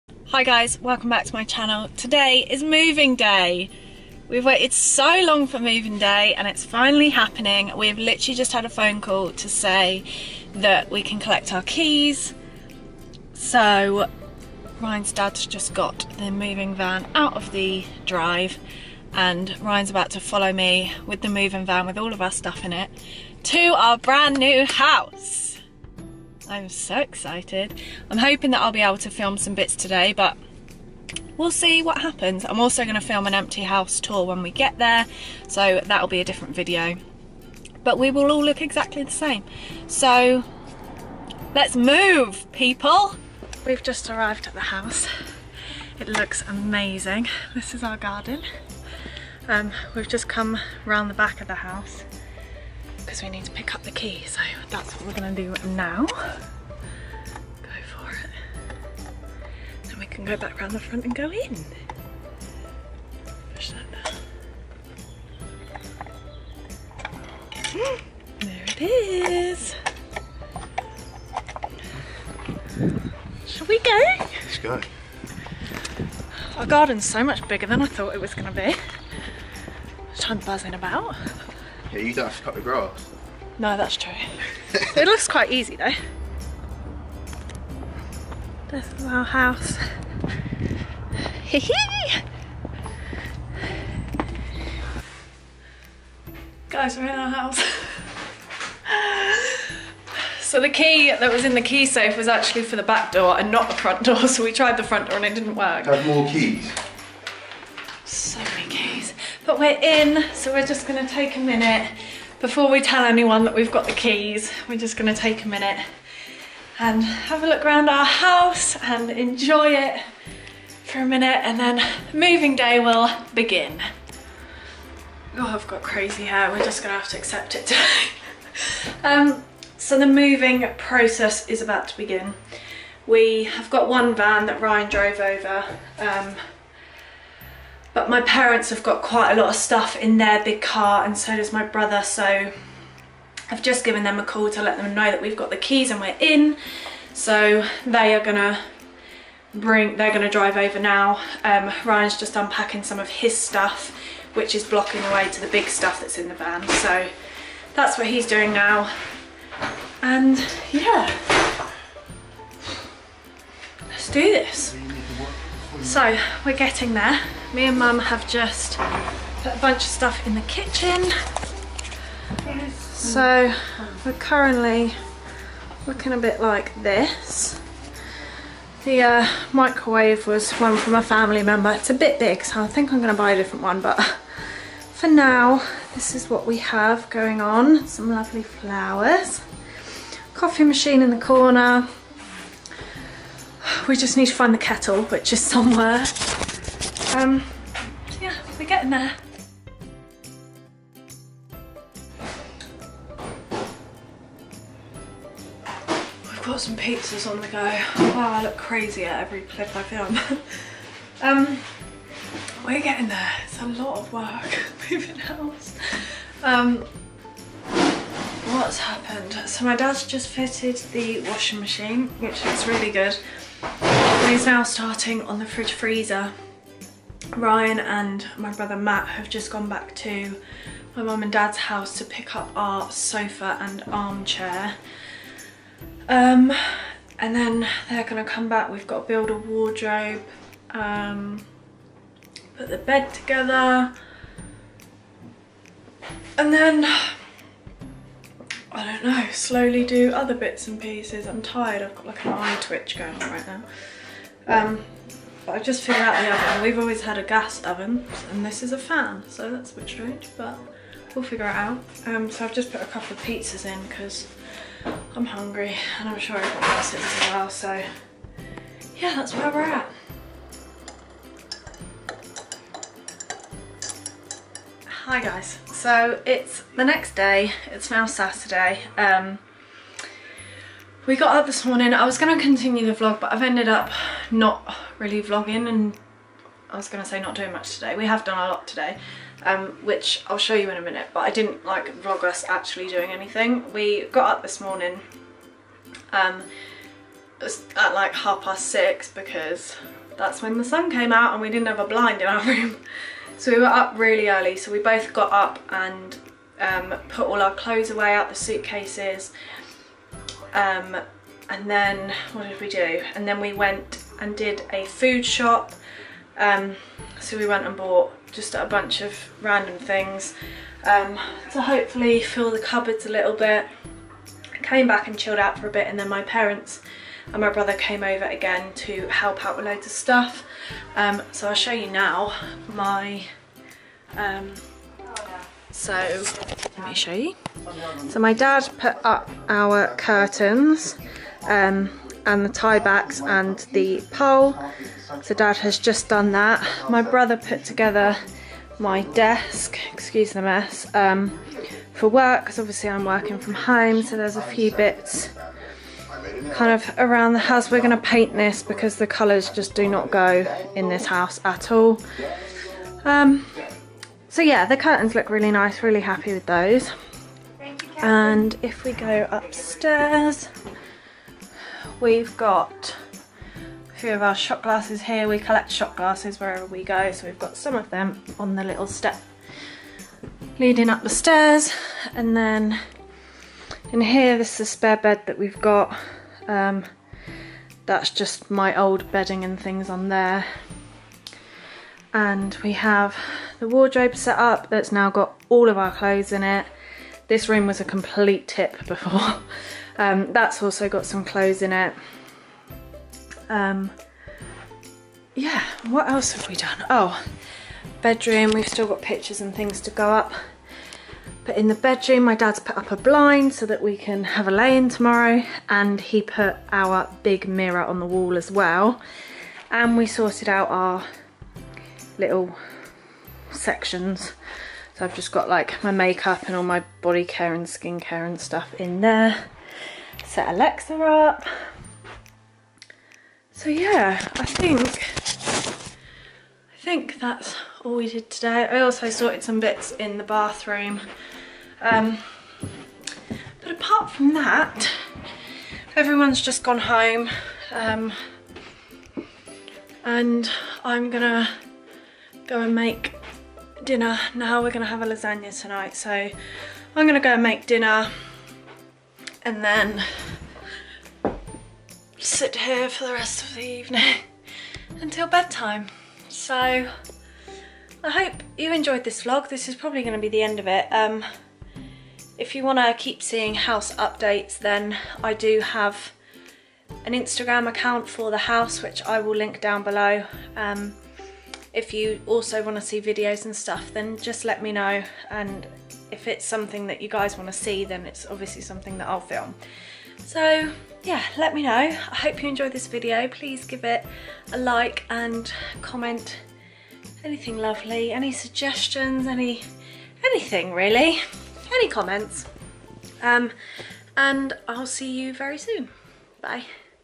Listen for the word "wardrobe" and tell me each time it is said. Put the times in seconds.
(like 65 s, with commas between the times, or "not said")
239 s, 393 s.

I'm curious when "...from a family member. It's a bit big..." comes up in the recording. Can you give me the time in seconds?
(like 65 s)
180 s.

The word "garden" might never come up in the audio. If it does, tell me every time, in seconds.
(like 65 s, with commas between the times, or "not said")
47 s, 76 s.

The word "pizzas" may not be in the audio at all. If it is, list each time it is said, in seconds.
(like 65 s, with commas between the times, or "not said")
206 s, 263 s.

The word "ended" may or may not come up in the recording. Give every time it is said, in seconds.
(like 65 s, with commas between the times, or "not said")
283 s.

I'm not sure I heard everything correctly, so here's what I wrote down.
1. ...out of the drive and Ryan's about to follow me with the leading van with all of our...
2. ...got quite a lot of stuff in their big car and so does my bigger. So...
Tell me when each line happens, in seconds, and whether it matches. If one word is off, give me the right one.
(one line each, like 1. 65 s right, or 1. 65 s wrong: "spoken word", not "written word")
1. 17 s wrong: "moving", not "leading"
2. 138 s wrong: "brother", not "bigger".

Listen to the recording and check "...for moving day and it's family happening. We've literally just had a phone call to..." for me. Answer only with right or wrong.
wrong.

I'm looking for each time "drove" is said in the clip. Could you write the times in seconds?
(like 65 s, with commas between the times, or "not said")
134 s.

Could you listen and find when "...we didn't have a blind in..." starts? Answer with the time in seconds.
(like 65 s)
301 s.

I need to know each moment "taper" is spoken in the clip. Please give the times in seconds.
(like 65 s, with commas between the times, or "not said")
not said.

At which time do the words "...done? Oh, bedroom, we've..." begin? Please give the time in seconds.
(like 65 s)
406 s.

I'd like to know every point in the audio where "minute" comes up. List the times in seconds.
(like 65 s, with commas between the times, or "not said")
111 s, 115 s, 121 s, 290 s.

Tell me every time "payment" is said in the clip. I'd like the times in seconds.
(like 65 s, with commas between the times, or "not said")
not said.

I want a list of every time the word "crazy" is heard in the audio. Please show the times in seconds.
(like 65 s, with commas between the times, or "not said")
125 s, 208 s.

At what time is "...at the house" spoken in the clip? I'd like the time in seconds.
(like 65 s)
44 s.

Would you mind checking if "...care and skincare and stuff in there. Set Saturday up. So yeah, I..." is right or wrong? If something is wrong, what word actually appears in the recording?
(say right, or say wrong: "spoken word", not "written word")
wrong: "Alexa", not "Saturday".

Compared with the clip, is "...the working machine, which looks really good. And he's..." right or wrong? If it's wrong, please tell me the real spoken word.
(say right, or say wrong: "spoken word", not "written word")
wrong: "washing", not "working".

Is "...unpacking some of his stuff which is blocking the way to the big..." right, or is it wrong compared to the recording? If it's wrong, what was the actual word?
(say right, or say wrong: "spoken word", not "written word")
right.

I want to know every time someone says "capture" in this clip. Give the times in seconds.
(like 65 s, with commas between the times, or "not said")
not said.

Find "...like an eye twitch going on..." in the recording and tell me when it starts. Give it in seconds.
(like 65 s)
252 s.